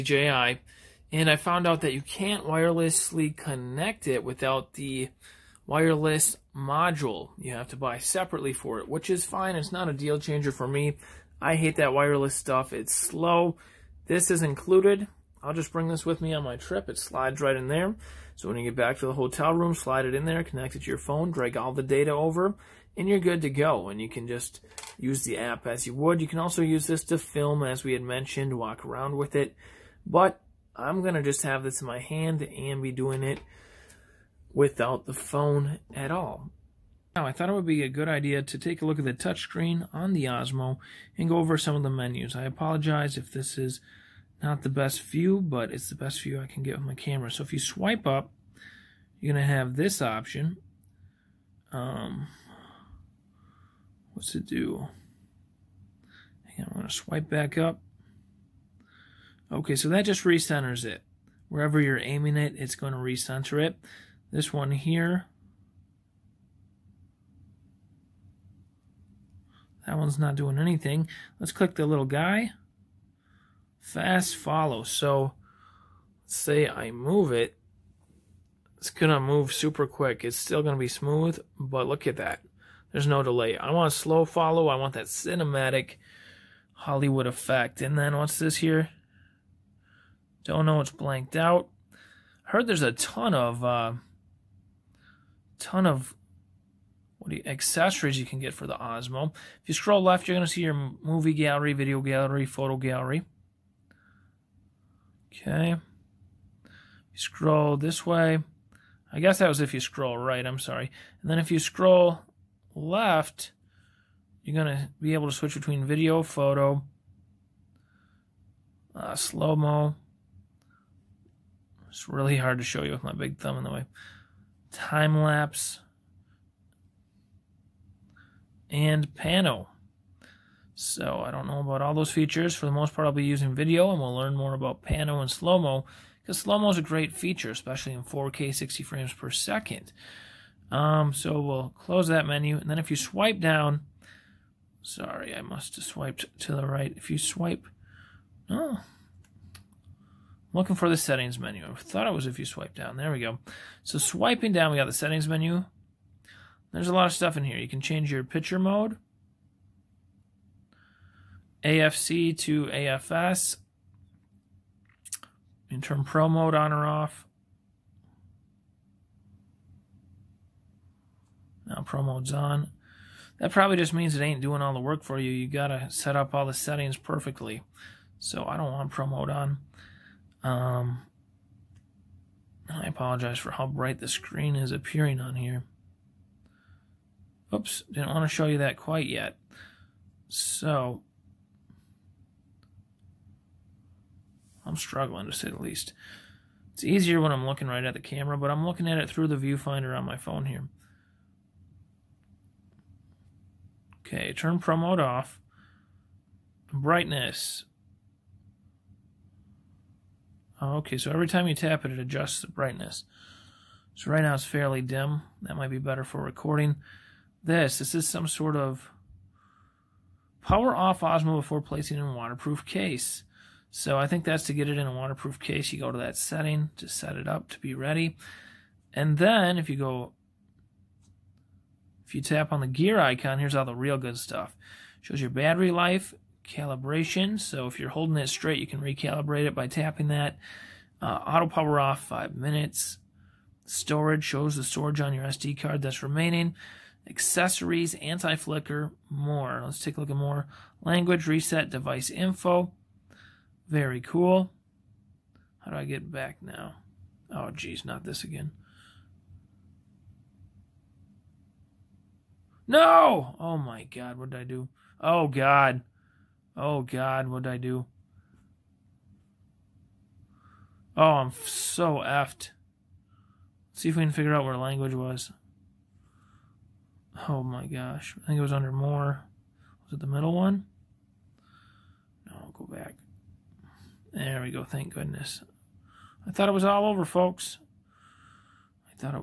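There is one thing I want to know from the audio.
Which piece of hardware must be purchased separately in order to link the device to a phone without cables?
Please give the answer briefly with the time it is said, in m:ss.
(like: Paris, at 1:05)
wireless module, at 0:05.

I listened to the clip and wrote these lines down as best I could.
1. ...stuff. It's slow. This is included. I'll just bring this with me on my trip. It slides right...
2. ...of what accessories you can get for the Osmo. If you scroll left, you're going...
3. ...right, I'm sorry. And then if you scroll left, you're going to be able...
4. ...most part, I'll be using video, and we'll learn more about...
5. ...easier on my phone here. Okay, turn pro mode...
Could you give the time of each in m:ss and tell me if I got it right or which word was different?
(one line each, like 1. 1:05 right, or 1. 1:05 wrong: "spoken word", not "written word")
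1. 0:12 right
2. 1:35 right
3. 1:50 right
4. 2:12 right
5. 3:19 wrong: "viewfinder", not "easier".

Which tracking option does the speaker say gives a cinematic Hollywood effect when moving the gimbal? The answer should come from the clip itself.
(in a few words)
slow follow.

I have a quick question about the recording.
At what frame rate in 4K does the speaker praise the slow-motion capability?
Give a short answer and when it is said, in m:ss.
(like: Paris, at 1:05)
60 frames per second, at 2:18.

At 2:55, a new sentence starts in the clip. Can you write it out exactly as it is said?
You gotta set up all the settings perfectly.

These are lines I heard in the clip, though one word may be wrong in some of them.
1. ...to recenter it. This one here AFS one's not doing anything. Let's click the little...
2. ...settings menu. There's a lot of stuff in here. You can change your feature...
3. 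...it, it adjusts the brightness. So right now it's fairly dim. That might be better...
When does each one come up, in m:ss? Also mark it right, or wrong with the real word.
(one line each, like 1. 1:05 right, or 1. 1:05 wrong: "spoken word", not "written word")
1. 1:02 wrong: "That", not "AFS"
2. 2:34 wrong: "picture", not "feature"
3. 3:31 right.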